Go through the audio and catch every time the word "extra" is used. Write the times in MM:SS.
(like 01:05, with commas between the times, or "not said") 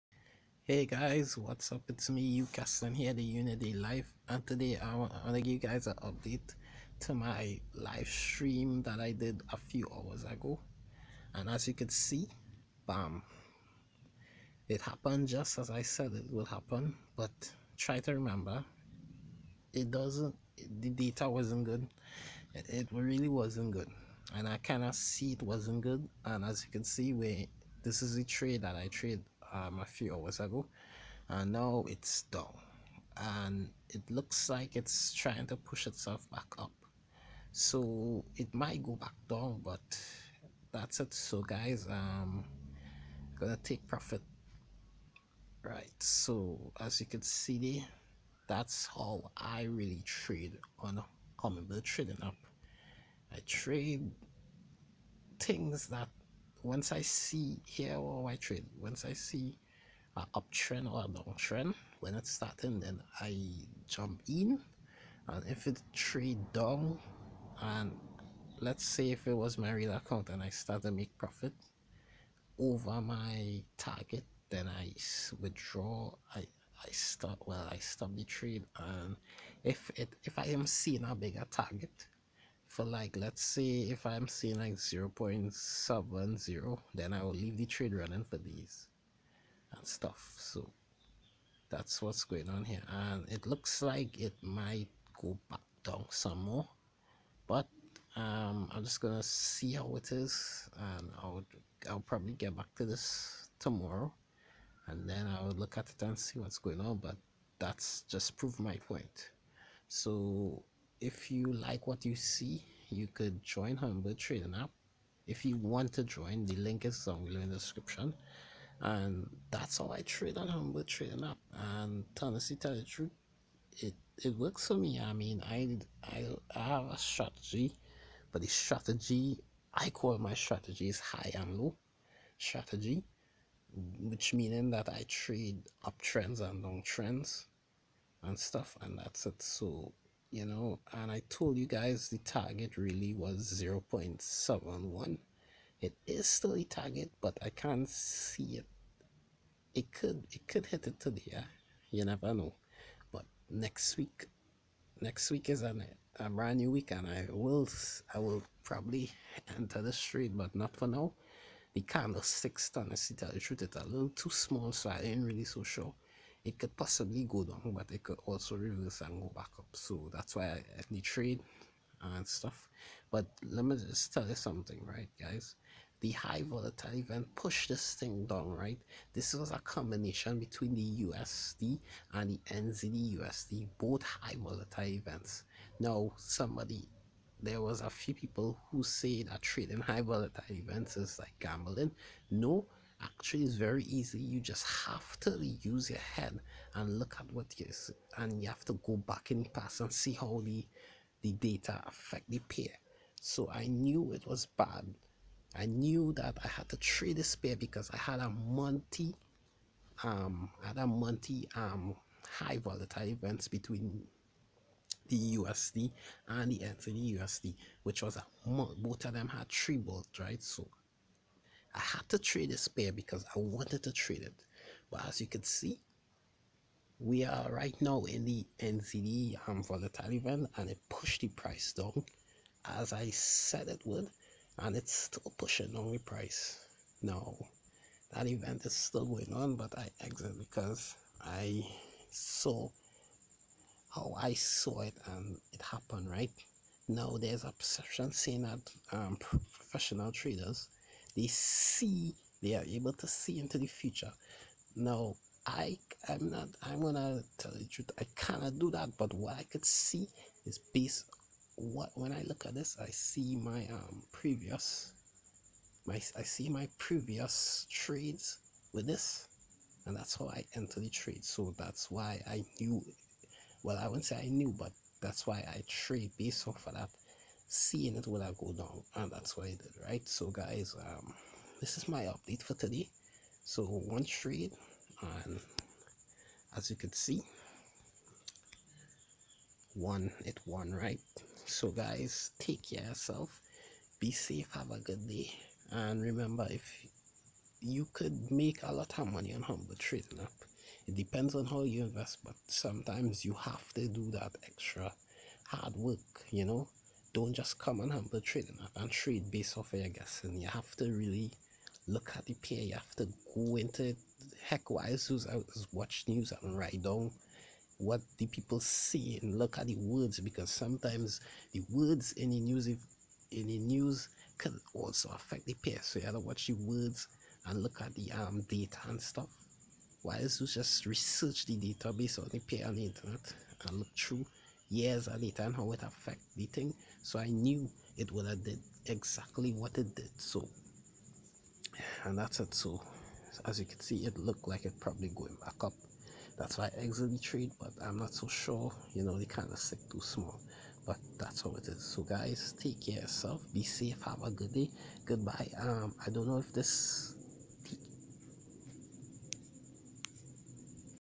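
05:04.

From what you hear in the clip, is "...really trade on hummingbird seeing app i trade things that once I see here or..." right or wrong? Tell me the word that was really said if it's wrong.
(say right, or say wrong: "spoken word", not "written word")
wrong: "trading", not "seeing".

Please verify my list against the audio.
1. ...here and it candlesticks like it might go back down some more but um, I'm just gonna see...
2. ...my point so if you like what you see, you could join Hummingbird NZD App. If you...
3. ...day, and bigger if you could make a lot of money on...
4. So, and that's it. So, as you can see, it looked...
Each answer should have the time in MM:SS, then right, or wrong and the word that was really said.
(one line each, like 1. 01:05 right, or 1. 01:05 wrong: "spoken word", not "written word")
1. 01:32 wrong: "looks", not "candlesticks"
2. 01:48 wrong: "Trading", not "NZD"
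3. 04:55 wrong: "remember", not "bigger"
4. 05:40 right.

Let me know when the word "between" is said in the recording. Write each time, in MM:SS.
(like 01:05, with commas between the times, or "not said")
03:00, 03:33.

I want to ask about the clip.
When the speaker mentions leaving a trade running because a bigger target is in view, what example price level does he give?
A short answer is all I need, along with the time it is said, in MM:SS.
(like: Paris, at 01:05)
0.70, at 01:24.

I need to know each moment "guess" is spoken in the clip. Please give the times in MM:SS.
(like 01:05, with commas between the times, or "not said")
05:09.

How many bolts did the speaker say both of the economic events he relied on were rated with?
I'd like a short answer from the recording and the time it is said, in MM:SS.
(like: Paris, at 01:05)
3, at 03:39.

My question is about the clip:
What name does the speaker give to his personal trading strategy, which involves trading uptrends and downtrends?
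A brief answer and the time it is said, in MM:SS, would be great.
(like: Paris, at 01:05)
high and low strategy, at 02:10.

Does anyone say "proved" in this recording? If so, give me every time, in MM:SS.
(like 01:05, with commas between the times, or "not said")
01:48.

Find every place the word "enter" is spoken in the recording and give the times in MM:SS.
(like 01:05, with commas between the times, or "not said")
02:39, 04:30.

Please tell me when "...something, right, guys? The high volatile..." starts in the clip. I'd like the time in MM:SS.
02:54.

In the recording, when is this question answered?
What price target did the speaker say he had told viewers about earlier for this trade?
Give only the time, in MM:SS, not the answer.
02:23.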